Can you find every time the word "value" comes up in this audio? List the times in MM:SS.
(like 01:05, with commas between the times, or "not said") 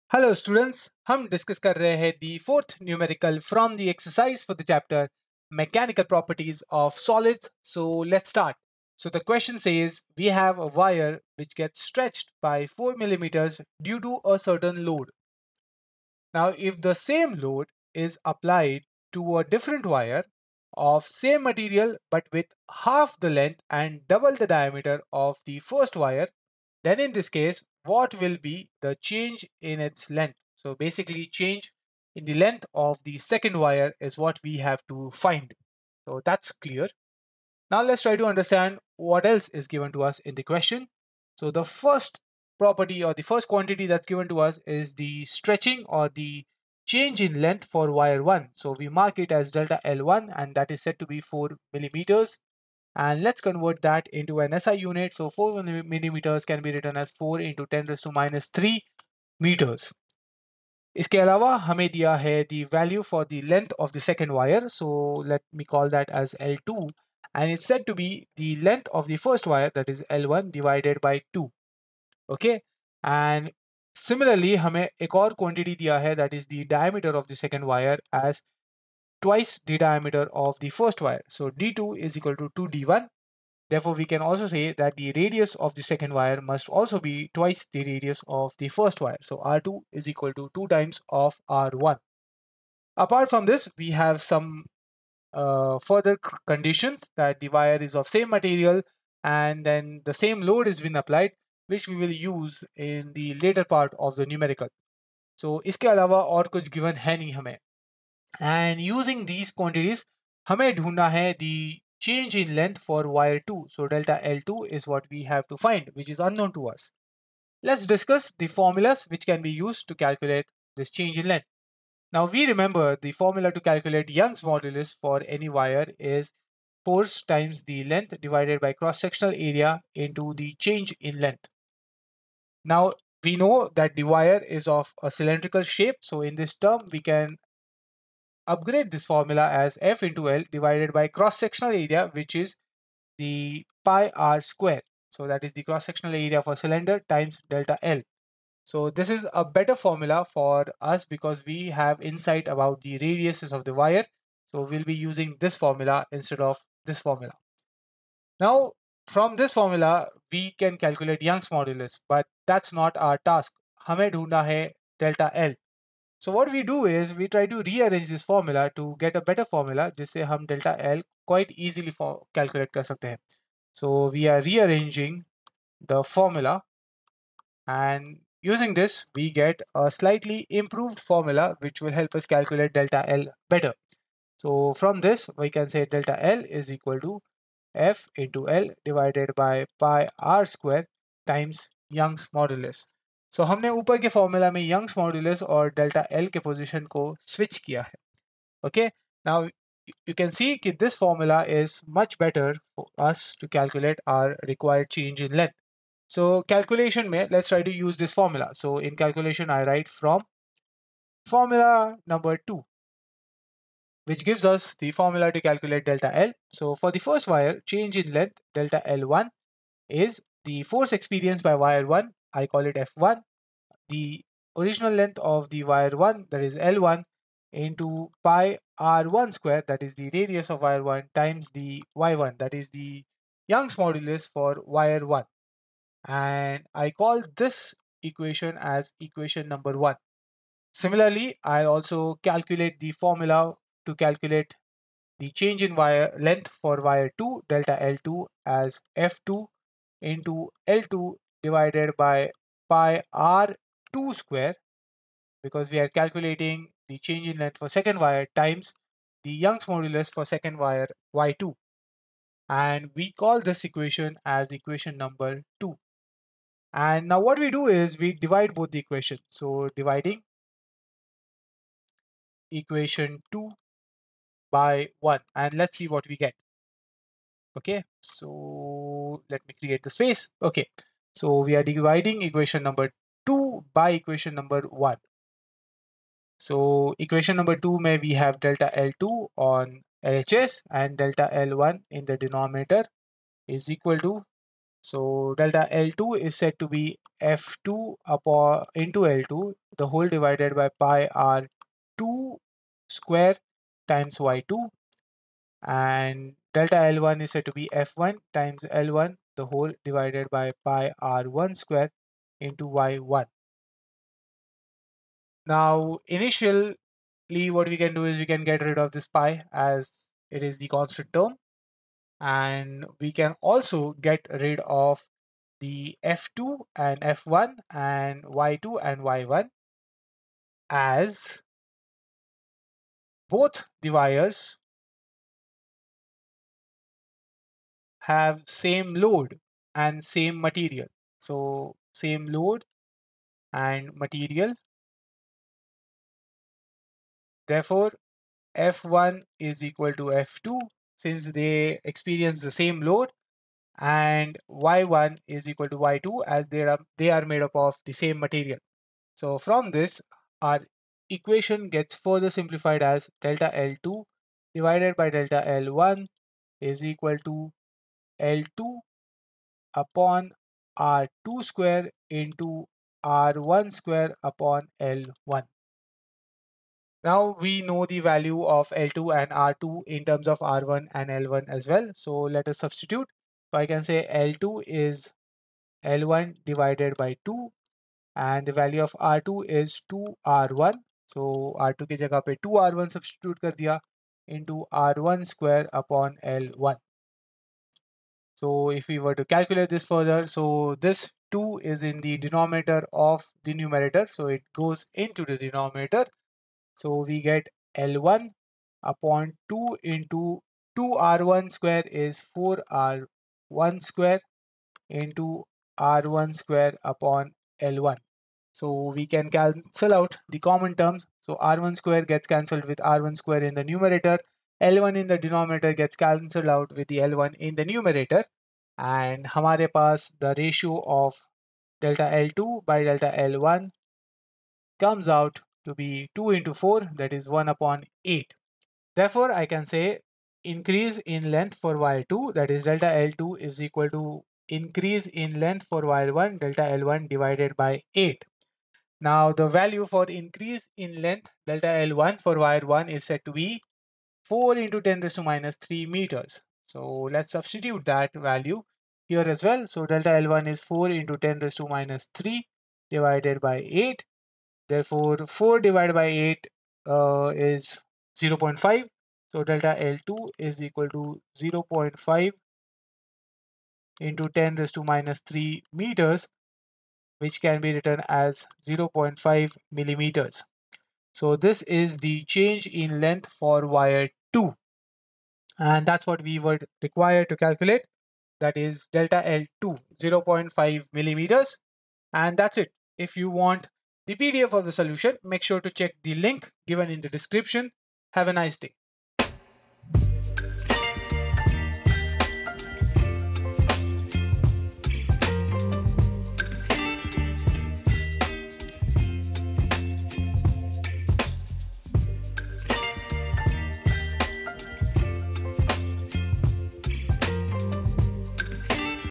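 01:02, 06:17, 06:28, 07:29, 07:38.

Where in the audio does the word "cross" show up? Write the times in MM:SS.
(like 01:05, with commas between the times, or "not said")
02:08, 02:21, 02:25.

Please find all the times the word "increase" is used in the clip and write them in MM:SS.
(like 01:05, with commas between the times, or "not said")
07:20, 07:24, 07:30.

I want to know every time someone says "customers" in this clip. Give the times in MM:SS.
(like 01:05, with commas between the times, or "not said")
not said.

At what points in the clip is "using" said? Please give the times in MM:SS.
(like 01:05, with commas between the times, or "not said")
01:48, 02:34, 02:58.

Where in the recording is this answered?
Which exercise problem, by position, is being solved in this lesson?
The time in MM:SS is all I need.
00:02.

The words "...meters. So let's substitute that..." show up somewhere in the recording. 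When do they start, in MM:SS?
07:35.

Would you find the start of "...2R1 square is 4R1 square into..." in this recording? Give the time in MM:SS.
06:50.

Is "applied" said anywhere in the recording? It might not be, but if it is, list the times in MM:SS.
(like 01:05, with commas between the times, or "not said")
00:18, 01:40.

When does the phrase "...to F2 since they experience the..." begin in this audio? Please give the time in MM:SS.
05:50.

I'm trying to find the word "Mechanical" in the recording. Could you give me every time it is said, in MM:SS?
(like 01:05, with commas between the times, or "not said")
00:05.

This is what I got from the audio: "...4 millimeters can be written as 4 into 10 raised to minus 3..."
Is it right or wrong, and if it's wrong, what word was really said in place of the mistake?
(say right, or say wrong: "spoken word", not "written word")
right.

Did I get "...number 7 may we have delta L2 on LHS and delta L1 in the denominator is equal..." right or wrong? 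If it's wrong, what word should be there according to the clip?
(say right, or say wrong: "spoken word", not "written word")
wrong: "2", not "7".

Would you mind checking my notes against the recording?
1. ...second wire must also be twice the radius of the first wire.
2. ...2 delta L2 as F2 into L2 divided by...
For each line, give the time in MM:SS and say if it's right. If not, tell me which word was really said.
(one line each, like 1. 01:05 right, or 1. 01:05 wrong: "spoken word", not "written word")
1. 01:25 right
2. 04:07 right.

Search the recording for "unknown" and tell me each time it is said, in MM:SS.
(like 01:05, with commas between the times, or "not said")
01:56.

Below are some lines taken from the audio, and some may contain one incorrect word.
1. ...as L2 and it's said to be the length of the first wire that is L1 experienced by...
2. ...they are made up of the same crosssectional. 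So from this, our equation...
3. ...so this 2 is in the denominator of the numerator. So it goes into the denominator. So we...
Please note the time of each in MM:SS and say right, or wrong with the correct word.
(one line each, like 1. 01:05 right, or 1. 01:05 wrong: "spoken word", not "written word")
1. 01:06 wrong: "divided", not "experienced"
2. 05:56 wrong: "material", not "crosssectional"
3. 06:40 right.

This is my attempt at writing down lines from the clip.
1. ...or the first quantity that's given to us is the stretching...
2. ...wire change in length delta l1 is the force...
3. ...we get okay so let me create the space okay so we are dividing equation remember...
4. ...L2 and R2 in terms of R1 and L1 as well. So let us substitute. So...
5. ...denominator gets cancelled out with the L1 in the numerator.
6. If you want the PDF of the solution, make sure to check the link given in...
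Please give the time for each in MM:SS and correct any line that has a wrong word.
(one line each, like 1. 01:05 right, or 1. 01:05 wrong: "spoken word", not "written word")
1. 00:43 right
2. 03:37 right
3. 04:36 wrong: "number", not "remember"
4. 06:18 right
5. 07:05 right
6. 08:12 right.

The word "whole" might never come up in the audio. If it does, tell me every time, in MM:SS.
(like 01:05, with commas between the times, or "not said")
04:59, 05:09.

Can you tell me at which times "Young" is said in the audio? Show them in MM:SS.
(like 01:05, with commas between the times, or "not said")
02:04, 02:41, 03:11, 03:53, 04:19.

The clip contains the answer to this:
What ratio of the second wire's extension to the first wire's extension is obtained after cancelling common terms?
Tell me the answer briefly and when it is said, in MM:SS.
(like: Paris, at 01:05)
1/8, at 07:17.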